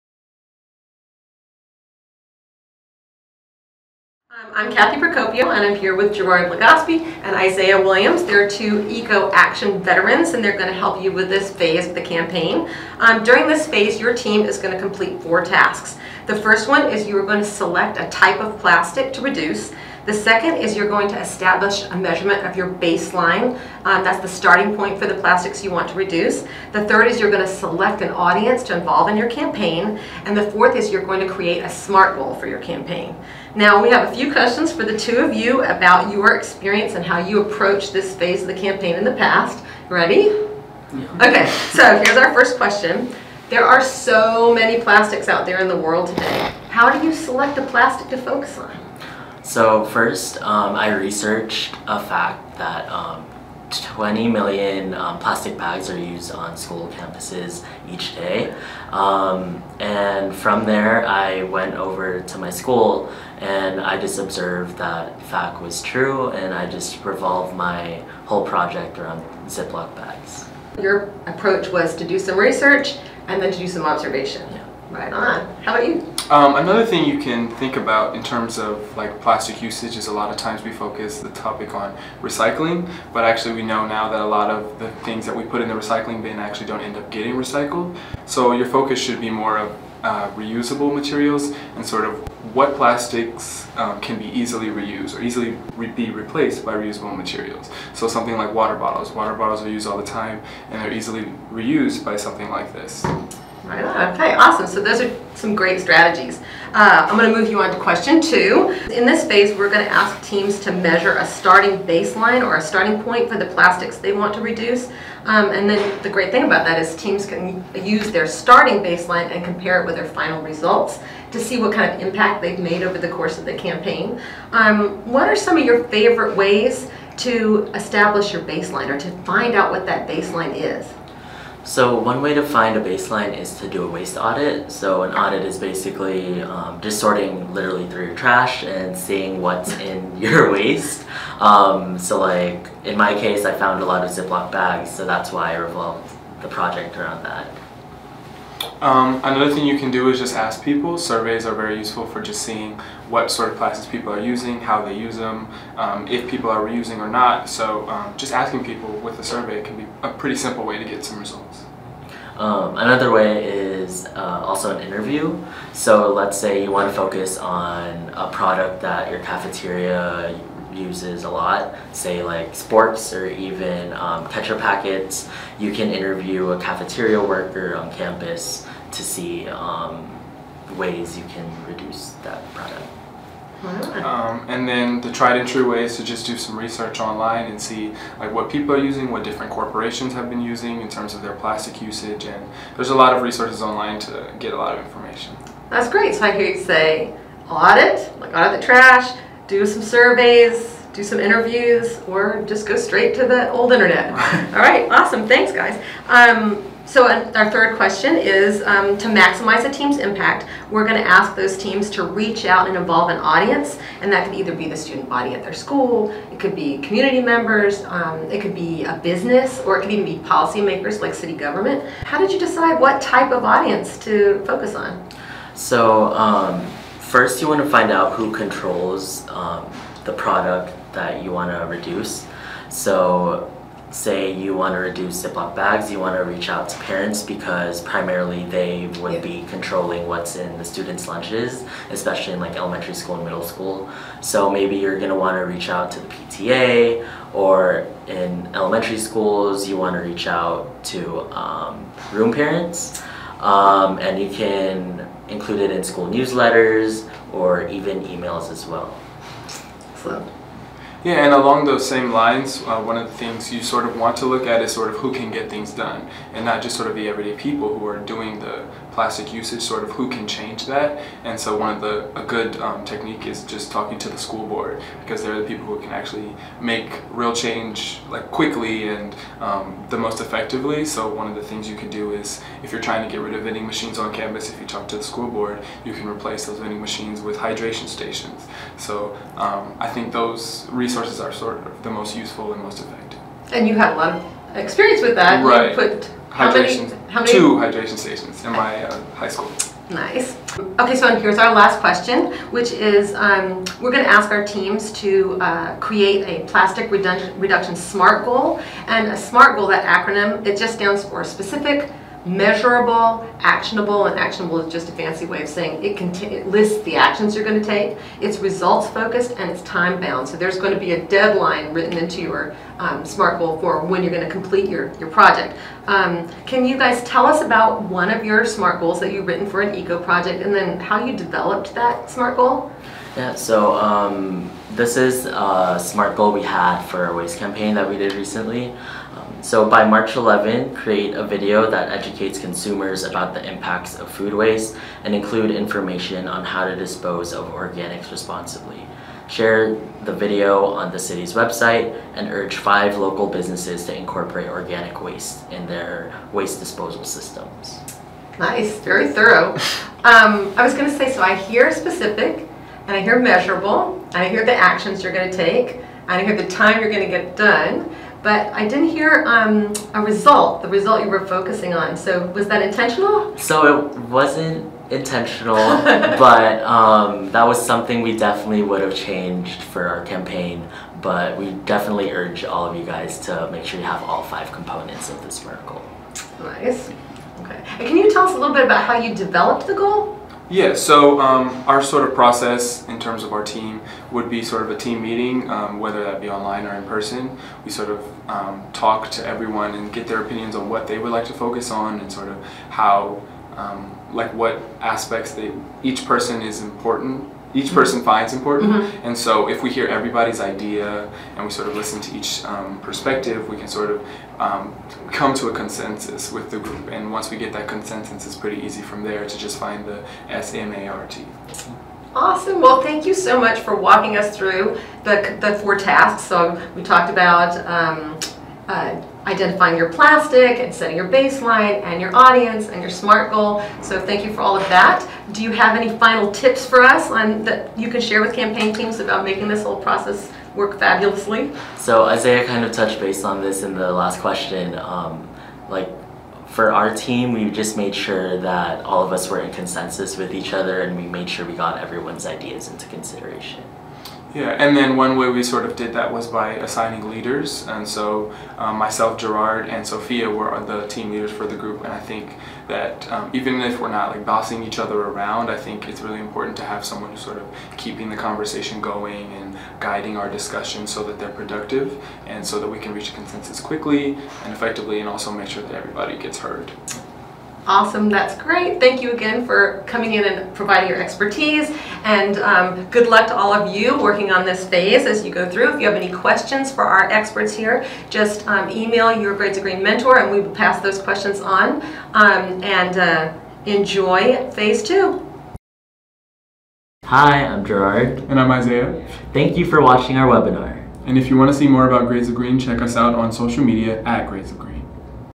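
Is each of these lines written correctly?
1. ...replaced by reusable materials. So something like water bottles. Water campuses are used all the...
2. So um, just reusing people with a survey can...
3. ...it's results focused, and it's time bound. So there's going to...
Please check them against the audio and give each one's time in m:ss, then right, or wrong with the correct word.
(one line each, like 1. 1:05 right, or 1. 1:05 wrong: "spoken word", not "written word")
1. 1:36 wrong: "bottles", not "campuses"
2. 2:37 wrong: "asking", not "reusing"
3. 5:18 right.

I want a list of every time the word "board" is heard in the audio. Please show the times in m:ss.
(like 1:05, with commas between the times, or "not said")
4:34, 4:45.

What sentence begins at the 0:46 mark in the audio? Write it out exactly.
How do you select a plastic to focus on?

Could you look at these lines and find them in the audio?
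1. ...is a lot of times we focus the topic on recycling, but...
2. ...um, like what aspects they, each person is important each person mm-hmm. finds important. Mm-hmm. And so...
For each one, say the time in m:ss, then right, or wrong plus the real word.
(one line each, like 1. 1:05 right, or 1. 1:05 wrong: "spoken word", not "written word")
1. 1:19 right
2. 6:43 right.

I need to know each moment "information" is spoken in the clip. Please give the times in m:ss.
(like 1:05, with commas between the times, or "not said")
3:14, 5:45.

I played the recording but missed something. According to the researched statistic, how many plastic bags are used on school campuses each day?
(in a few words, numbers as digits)
20 million.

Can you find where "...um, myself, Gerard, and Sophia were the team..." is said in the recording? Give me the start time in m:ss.
7:38.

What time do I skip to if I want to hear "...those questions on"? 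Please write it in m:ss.
8:10.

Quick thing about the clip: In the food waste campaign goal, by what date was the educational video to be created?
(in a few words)
March 11.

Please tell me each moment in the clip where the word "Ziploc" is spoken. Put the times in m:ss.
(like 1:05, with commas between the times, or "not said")
1:09, 2:24, 3:55.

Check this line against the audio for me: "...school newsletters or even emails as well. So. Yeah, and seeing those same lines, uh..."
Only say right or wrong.
wrong.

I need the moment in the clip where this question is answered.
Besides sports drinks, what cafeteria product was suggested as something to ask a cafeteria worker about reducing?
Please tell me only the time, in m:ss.
2:54.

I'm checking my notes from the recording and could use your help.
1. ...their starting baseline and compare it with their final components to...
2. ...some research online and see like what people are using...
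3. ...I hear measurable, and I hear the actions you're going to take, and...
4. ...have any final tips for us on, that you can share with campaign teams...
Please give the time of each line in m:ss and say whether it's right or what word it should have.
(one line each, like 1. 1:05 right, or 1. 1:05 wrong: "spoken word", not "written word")
1. 1:58 wrong: "results", not "components"
2. 3:06 right
3. 6:02 right
4. 7:15 right.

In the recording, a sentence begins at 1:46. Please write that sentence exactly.
Uh, I'm going to move you on to question two.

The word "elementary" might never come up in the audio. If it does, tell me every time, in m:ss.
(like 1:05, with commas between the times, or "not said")
4:02, 4:08.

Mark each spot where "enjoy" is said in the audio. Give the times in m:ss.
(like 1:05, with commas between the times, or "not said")
8:13.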